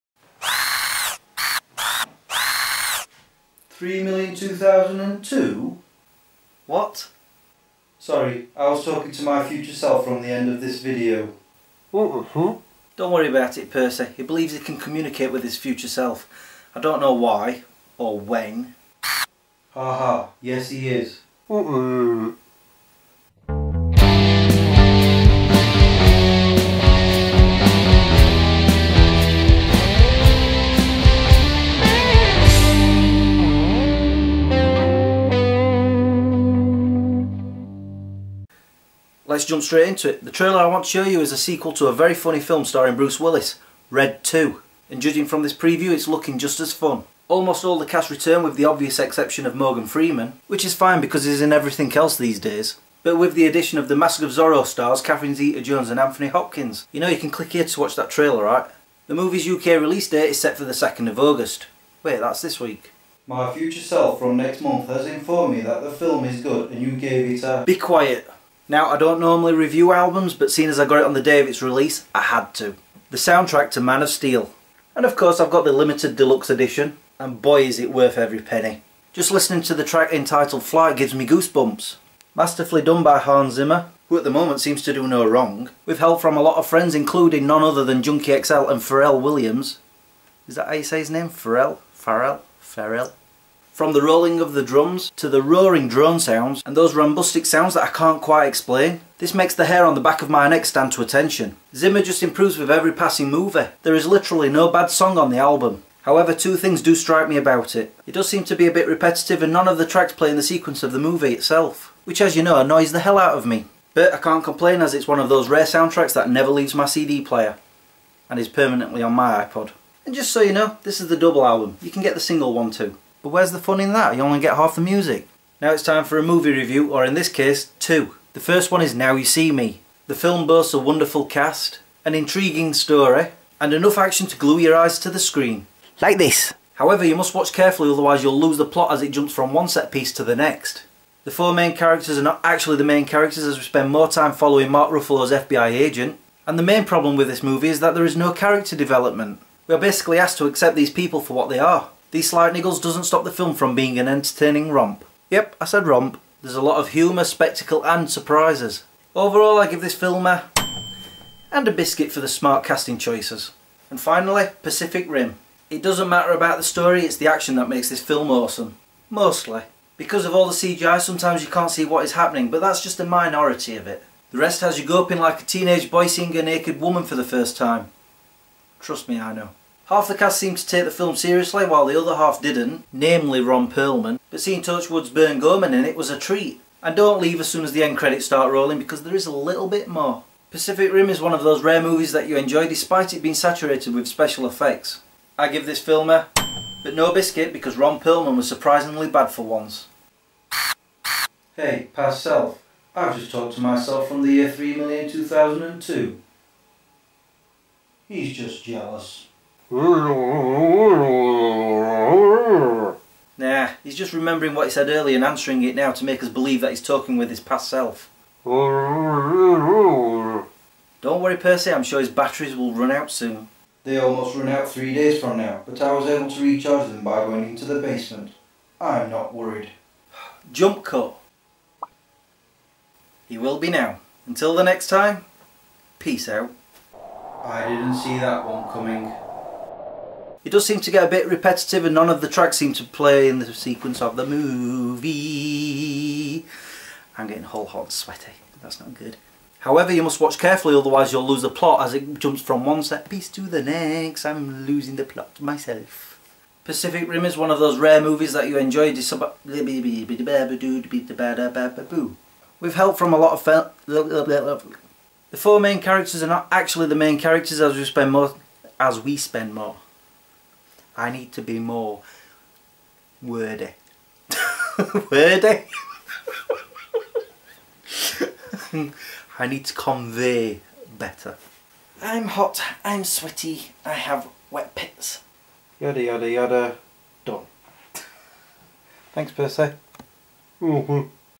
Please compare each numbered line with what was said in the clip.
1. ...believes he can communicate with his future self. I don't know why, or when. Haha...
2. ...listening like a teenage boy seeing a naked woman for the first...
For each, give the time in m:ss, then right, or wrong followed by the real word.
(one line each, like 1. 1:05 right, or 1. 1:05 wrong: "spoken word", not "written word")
1. 0:14 right
2. 2:54 wrong: "goping", not "listening".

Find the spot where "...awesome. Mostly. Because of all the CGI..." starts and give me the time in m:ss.
2:48.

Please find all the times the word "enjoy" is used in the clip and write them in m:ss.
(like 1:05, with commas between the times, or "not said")
3:12, 4:18.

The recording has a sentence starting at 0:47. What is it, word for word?
Almost all the cast return with the obvious exception of Morgan Freeman, which is fine because he's in everything else these days.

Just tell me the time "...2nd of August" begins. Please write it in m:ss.
1:00.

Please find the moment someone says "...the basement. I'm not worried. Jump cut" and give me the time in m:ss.
3:47.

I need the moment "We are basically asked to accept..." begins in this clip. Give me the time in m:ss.
2:29.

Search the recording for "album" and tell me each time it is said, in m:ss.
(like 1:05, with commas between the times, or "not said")
1:09, 1:45, 2:01.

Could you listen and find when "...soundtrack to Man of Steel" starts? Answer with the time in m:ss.
1:13.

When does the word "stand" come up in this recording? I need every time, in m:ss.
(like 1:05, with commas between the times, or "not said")
1:40.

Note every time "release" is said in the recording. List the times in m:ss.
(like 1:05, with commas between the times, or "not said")
0:59, 1:11.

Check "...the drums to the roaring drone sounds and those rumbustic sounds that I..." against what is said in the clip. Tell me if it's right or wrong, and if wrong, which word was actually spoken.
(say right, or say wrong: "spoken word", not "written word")
right.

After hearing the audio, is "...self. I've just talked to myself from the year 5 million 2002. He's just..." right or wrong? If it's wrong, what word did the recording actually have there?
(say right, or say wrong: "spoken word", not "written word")
wrong: "3", not "5".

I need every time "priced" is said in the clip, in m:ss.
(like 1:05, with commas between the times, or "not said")
not said.